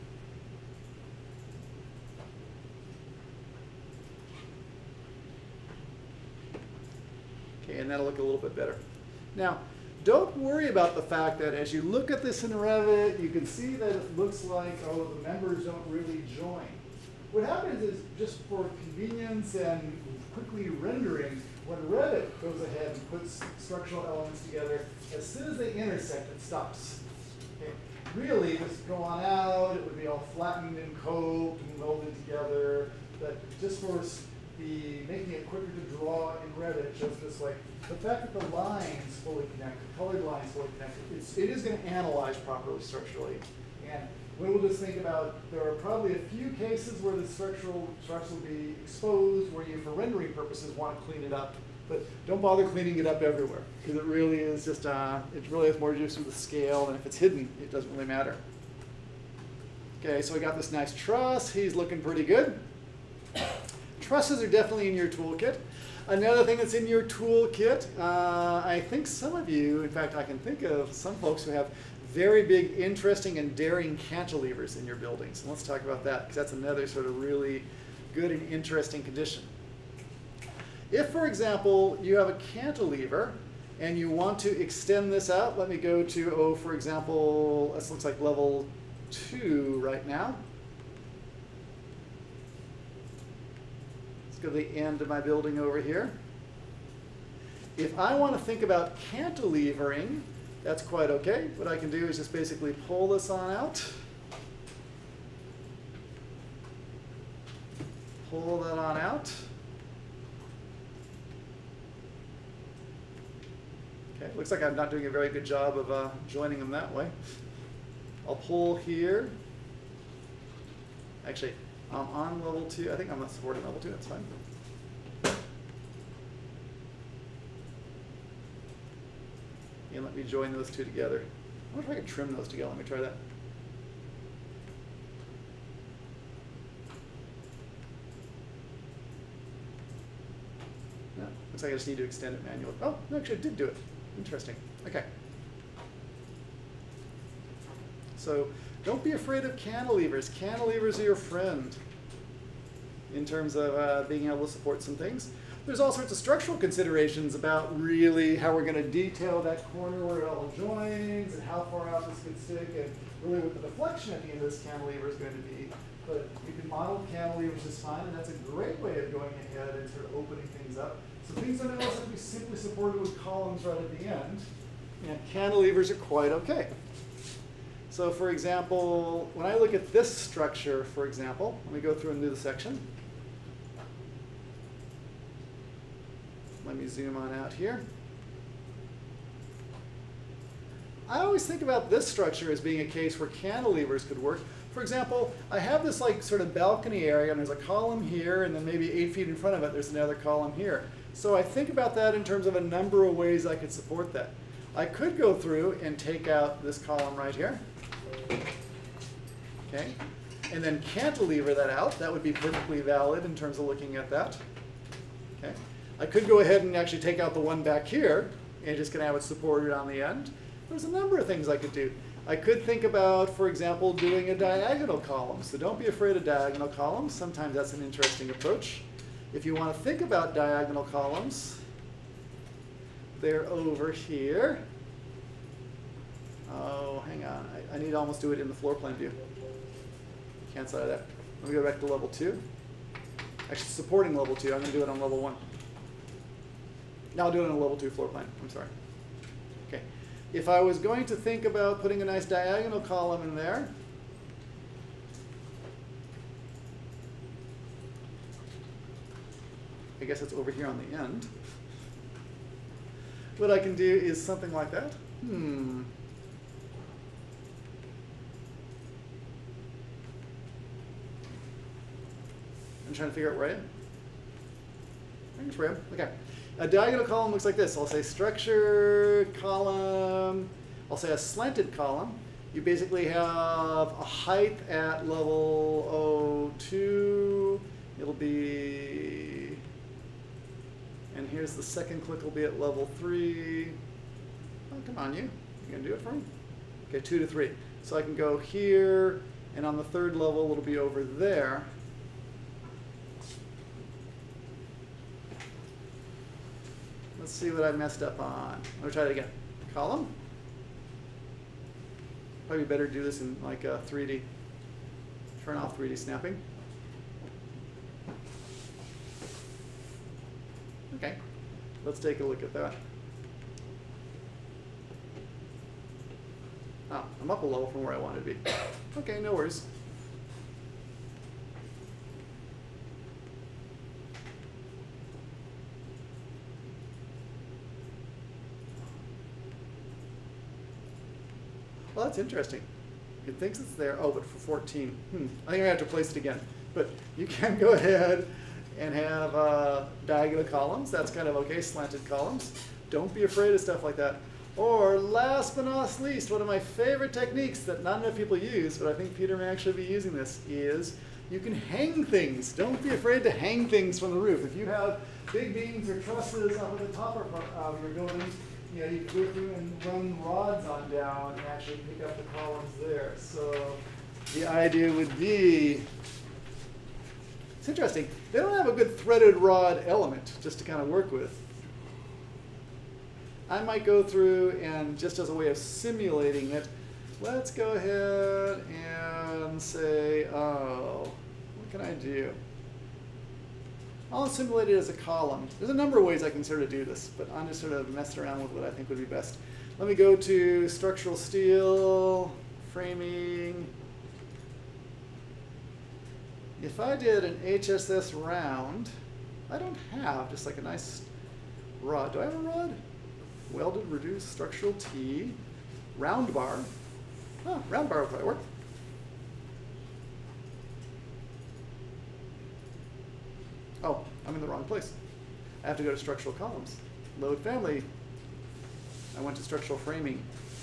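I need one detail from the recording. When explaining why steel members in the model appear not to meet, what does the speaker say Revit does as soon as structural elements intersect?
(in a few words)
It stops.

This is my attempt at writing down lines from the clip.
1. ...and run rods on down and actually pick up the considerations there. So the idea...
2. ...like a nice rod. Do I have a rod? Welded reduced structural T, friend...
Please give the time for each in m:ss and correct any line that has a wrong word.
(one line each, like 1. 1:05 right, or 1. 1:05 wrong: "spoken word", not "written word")
1. 6:09 wrong: "columns", not "considerations"
2. 6:50 wrong: "round", not "friend".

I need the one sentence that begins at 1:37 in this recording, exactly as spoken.
If I want to think about cantilevering, that's quite okay.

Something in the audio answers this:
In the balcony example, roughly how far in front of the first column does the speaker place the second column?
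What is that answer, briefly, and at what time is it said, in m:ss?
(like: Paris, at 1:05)
8 feet, at 3:18.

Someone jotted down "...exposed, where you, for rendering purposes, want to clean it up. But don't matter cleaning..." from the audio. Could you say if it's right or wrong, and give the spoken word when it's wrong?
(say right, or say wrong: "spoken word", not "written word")
wrong: "bother", not "matter".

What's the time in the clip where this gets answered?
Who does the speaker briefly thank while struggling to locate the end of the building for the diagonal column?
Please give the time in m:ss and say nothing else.
4:35.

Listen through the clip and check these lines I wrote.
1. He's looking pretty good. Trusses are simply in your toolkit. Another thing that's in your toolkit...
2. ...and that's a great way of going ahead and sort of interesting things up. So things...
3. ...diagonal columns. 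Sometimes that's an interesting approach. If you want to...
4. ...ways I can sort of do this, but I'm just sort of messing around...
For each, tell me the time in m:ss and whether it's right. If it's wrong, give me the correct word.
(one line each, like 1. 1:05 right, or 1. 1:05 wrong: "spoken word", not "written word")
1. 1:01 wrong: "definitely", not "simply"
2. 2:48 wrong: "opening", not "interesting"
3. 3:46 right
4. 6:36 right.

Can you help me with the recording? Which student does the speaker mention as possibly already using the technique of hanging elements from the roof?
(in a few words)
Peter.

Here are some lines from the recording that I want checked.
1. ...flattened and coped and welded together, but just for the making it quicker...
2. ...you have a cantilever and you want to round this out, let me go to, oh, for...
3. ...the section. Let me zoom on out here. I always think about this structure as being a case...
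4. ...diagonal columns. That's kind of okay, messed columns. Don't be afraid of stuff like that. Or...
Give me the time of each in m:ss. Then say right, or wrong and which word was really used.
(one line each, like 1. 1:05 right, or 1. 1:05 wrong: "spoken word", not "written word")
1. 0:30 right
2. 1:22 wrong: "extend", not "round"
3. 3:02 right
4. 5:50 wrong: "slanted", not "messed".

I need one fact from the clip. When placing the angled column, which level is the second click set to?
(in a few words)
Level 3.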